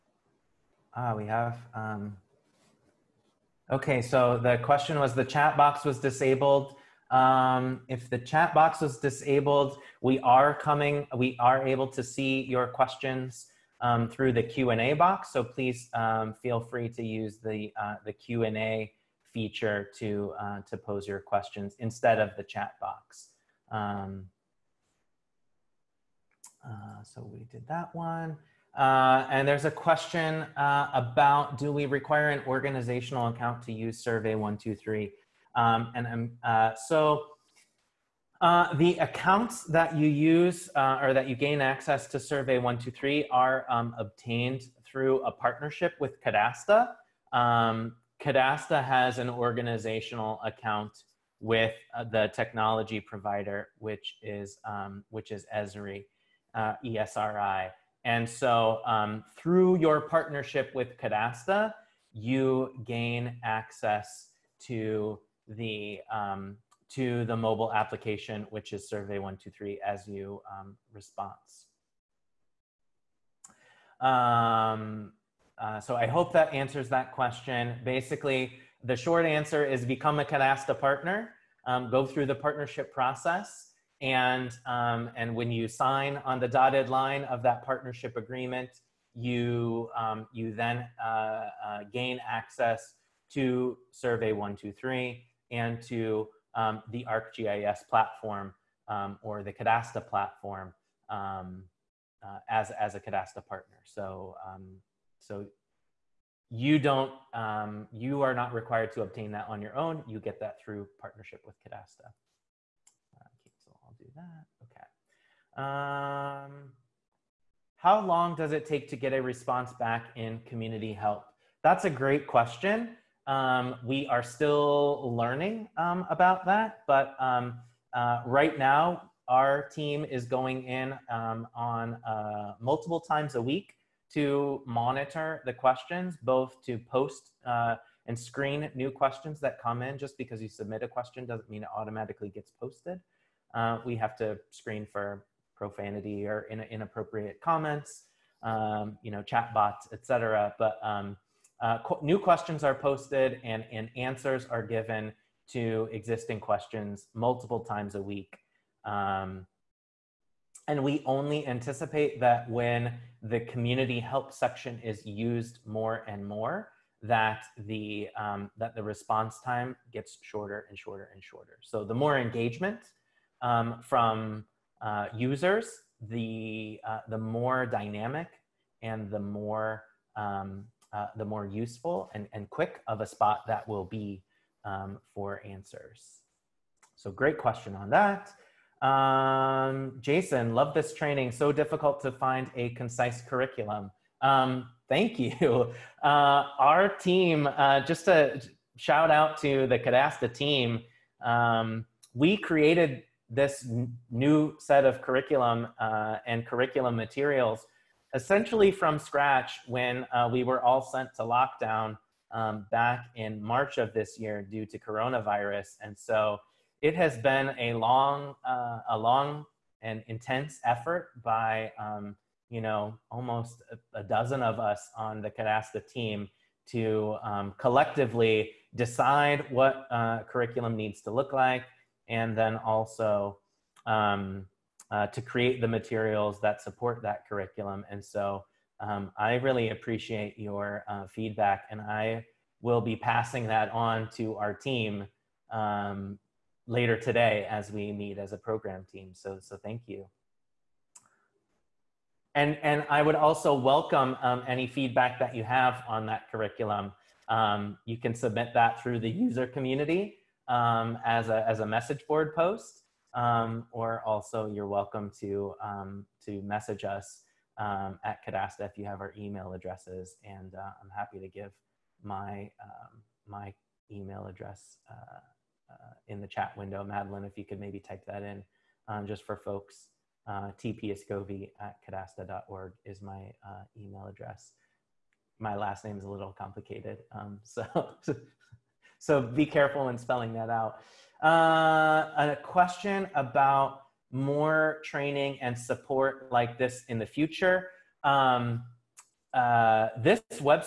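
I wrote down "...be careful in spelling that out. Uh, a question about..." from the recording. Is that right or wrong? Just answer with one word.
right.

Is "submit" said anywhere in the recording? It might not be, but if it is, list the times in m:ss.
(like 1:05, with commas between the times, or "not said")
2:20, 4:18.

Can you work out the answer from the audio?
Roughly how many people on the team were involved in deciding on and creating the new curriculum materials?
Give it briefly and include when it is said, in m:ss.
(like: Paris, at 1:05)
almost a dozen, at 3:43.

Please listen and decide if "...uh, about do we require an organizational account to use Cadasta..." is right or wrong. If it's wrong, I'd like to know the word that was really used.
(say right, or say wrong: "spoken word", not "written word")
wrong: "Survey", not "Cadasta".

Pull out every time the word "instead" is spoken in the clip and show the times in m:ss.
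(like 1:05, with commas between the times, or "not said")
0:21.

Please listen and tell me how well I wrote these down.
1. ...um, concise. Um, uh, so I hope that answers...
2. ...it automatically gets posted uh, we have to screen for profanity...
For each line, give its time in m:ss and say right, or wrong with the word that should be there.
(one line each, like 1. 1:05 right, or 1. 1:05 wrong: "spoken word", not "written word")
1. 1:10 wrong: "response", not "concise"
2. 2:21 right.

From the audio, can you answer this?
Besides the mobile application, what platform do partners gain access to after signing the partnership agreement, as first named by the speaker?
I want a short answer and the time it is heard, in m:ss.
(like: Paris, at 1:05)
ArcGIS, at 1:37.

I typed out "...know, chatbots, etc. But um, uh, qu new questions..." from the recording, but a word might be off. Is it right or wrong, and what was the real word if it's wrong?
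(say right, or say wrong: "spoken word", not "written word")
right.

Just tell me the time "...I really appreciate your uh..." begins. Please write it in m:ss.
3:59.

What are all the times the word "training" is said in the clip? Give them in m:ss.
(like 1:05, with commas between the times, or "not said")
3:10, 4:54.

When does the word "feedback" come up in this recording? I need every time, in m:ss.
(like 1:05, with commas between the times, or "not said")
4:01, 4:14.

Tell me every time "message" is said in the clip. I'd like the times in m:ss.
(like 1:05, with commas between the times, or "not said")
4:21, 4:26.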